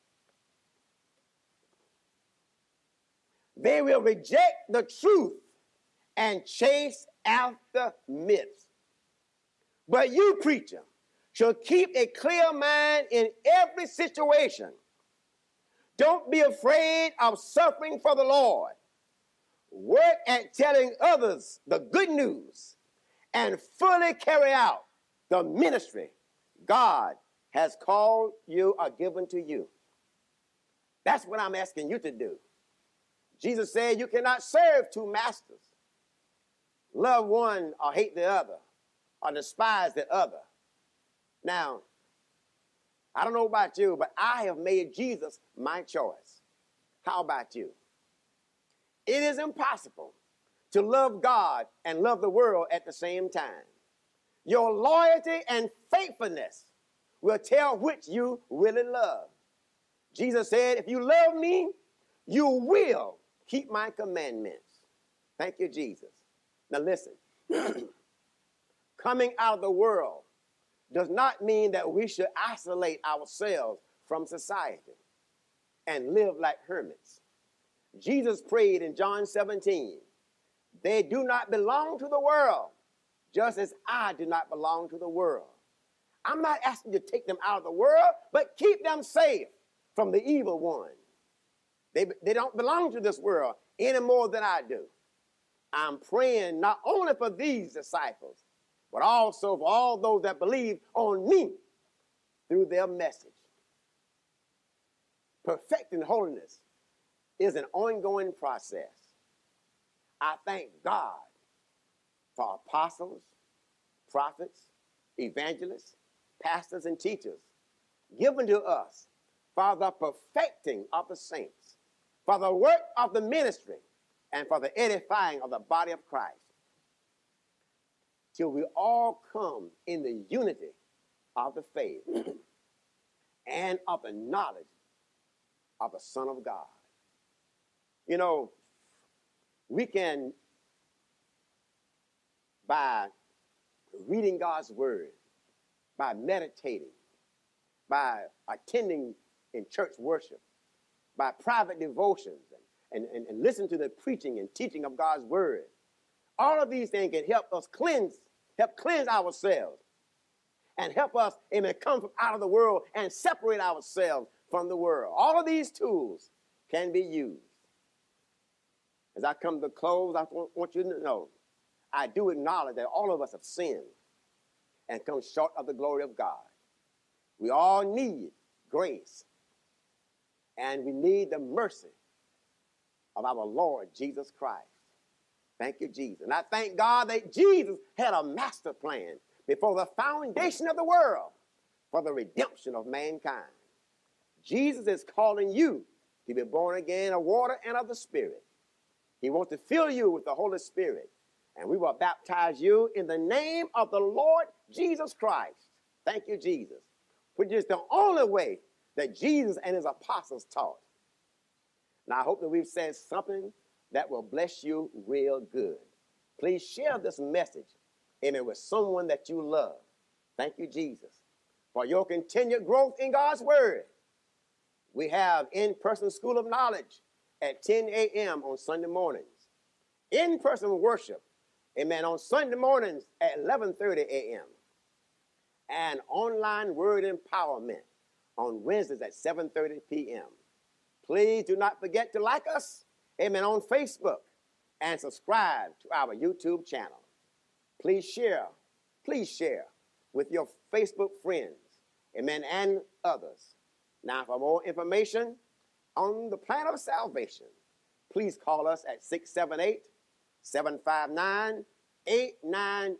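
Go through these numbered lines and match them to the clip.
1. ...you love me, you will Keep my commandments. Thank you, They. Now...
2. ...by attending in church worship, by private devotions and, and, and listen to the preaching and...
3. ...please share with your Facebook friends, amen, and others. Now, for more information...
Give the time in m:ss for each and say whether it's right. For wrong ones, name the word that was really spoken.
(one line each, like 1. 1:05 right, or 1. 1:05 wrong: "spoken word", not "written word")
1. 1:00 wrong: "Jesus", not "They"
2. 2:27 right
3. 4:09 right.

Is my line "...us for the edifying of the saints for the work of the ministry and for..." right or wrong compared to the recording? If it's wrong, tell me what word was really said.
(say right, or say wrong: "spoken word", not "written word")
wrong: "perfecting", not "edifying".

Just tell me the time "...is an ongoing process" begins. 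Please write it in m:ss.
1:47.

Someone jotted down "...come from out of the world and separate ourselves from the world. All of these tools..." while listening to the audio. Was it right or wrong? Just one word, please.
right.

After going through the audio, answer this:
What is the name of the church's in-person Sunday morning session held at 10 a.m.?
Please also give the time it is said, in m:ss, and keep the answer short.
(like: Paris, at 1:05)
School of Knowledge, at 3:46.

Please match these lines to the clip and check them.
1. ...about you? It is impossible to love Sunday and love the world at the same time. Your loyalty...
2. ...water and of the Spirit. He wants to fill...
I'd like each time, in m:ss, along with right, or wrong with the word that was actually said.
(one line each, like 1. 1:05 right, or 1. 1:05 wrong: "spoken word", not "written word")
1. 0:47 wrong: "God", not "Sunday"
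2. 3:17 right.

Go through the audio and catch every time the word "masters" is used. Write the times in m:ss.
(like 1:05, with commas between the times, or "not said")
0:35, 3:08.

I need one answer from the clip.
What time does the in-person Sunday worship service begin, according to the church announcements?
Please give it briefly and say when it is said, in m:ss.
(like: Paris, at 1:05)
11:30 a.m., at 3:53.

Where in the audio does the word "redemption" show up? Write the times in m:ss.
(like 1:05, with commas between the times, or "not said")
3:12.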